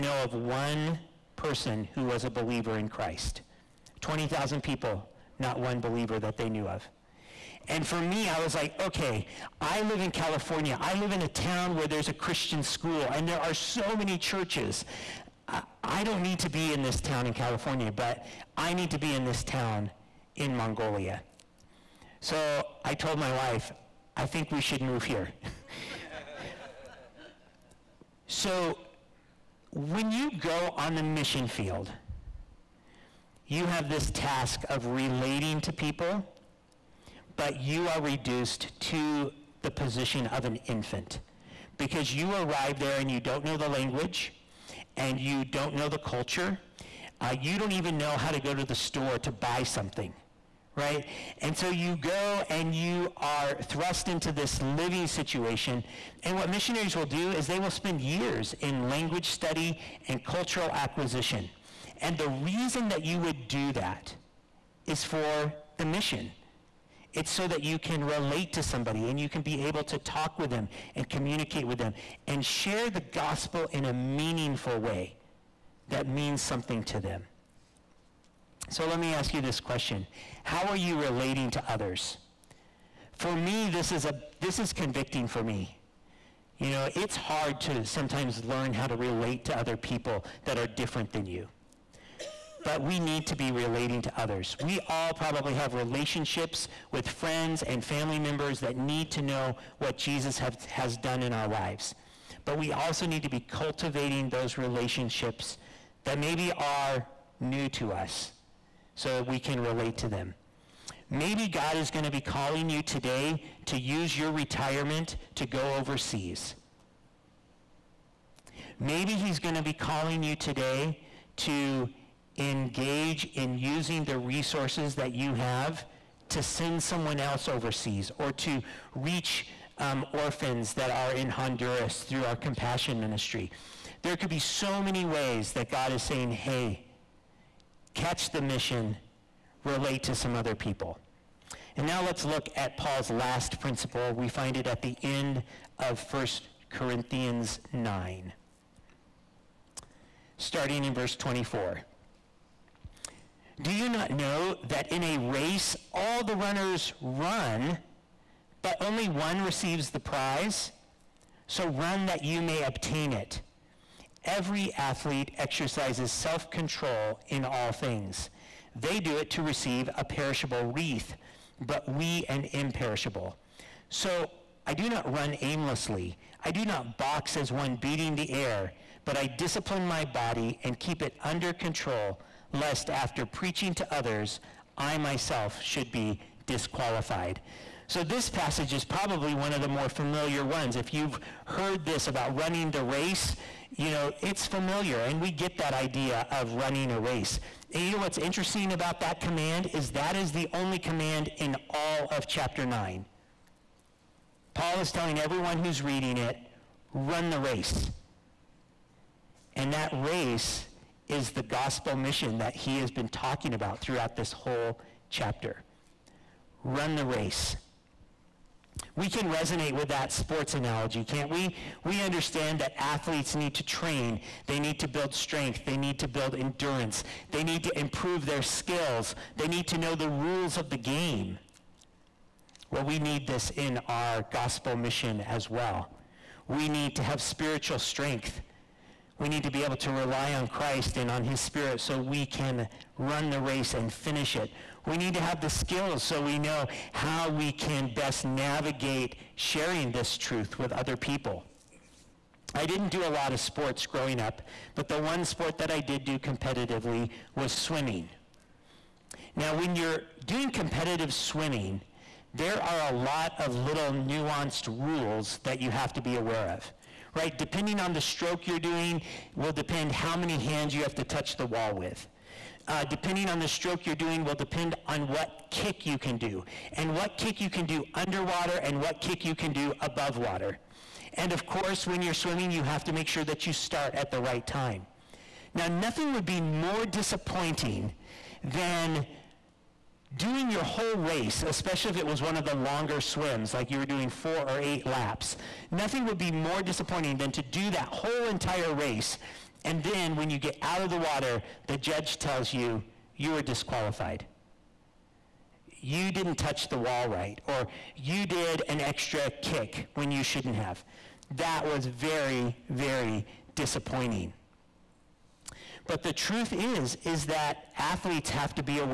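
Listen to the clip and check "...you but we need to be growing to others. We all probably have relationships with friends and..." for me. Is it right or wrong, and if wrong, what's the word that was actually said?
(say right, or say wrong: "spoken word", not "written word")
wrong: "relating", not "growing".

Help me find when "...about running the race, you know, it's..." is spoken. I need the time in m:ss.
3:12.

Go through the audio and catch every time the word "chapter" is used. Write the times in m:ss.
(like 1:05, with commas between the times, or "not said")
3:22, 3:35.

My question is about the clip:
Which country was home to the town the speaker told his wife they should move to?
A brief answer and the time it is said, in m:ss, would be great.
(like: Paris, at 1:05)
Mongolia, at 0:20.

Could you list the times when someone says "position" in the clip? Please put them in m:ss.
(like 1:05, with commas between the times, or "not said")
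0:39.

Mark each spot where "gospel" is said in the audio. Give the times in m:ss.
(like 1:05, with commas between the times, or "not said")
1:12, 3:31, 3:54.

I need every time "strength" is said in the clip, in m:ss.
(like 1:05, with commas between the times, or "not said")
3:45, 3:57.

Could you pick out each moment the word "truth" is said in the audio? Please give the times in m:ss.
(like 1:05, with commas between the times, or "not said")
4:10, 5:16.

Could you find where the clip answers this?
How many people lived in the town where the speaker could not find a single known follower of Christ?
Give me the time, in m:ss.
0:04.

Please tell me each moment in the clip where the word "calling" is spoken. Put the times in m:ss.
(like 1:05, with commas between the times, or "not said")
1:52, 1:59.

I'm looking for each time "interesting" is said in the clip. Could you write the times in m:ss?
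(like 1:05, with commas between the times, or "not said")
3:18.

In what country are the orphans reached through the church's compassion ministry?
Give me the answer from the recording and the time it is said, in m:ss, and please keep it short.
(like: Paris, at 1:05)
Honduras, at 2:11.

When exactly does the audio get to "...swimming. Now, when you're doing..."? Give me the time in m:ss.
4:17.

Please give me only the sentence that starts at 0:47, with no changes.
Uh, you don't even know how to go to the store to buy something, right?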